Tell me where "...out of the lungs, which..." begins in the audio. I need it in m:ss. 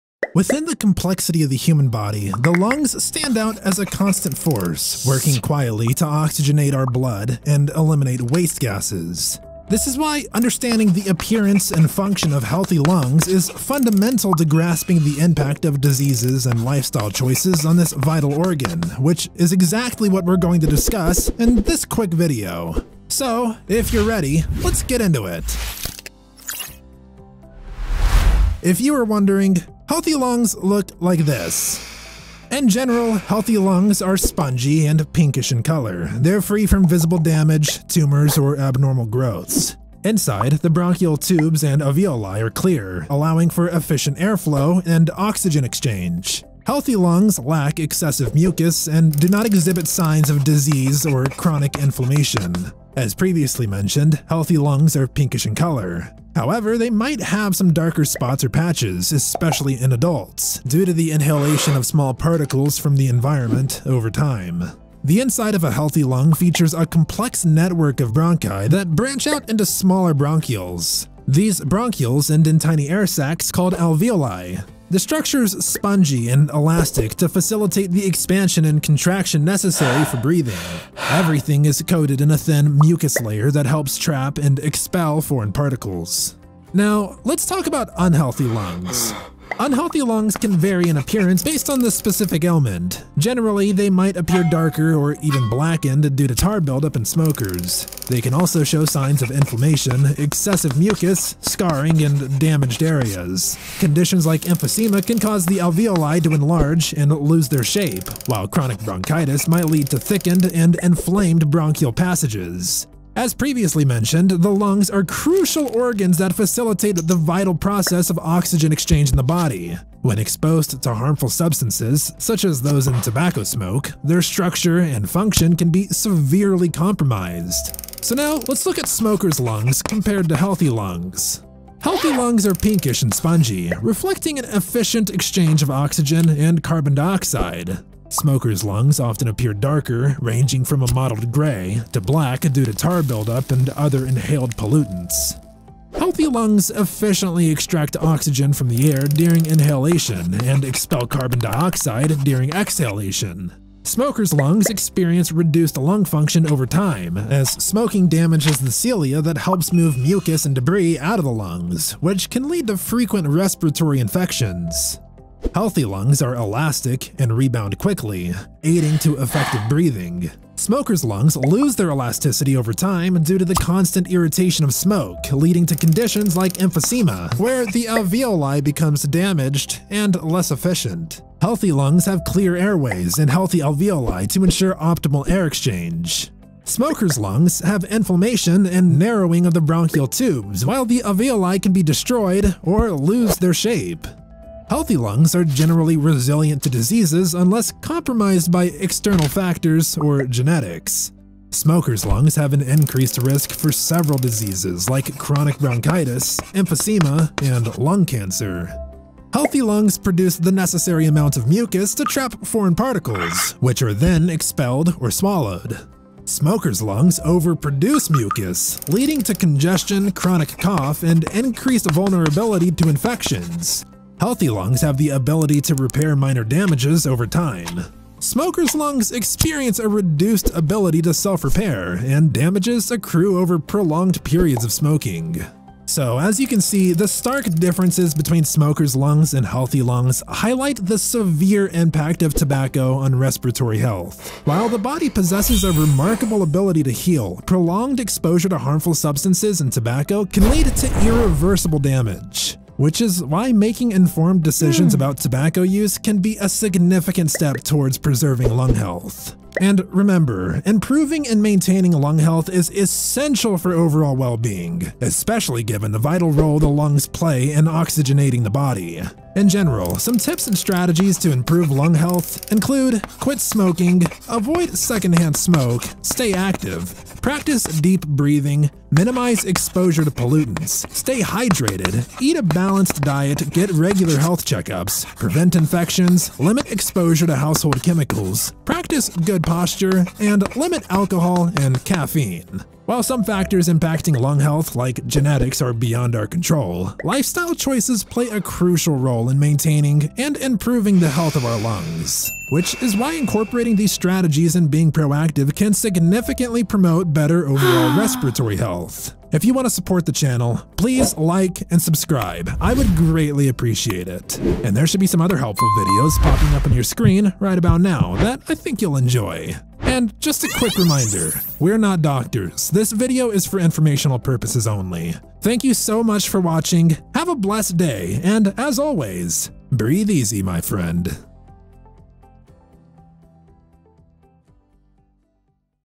2:40.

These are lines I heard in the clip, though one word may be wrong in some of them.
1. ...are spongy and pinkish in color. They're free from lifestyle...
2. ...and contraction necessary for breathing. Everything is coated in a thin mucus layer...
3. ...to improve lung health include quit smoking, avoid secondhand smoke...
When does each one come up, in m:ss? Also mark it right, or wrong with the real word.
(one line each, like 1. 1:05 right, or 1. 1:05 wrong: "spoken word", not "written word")
1. 0:34 wrong: "visible", not "lifestyle"
2. 1:18 right
3. 4:31 right.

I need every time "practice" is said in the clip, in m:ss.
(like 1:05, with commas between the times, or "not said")
4:37, 4:48.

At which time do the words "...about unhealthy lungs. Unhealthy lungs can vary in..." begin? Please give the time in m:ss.
1:27.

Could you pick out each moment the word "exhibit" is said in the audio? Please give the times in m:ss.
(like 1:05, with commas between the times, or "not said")
0:49.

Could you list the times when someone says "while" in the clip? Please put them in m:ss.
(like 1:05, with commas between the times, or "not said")
1:48, 3:10, 4:04, 4:52.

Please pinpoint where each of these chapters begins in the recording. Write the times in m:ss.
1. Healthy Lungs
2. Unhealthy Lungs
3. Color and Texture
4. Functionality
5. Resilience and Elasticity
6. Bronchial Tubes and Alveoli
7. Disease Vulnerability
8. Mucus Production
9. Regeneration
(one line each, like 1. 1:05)
1. 0:28
2. 1:28
3. 2:13
4. 2:26
5. 2:47
6. 3:02
7. 3:15
8. 3:30
9. 3:46.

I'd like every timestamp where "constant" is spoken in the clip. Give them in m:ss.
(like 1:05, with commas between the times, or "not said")
0:03, 2:53.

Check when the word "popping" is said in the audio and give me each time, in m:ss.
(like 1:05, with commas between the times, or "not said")
5:16.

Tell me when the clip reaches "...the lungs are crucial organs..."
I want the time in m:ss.
1:54.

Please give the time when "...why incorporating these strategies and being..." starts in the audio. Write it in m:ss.
5:02.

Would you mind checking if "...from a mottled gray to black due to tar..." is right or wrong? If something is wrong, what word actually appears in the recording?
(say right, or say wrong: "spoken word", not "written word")
right.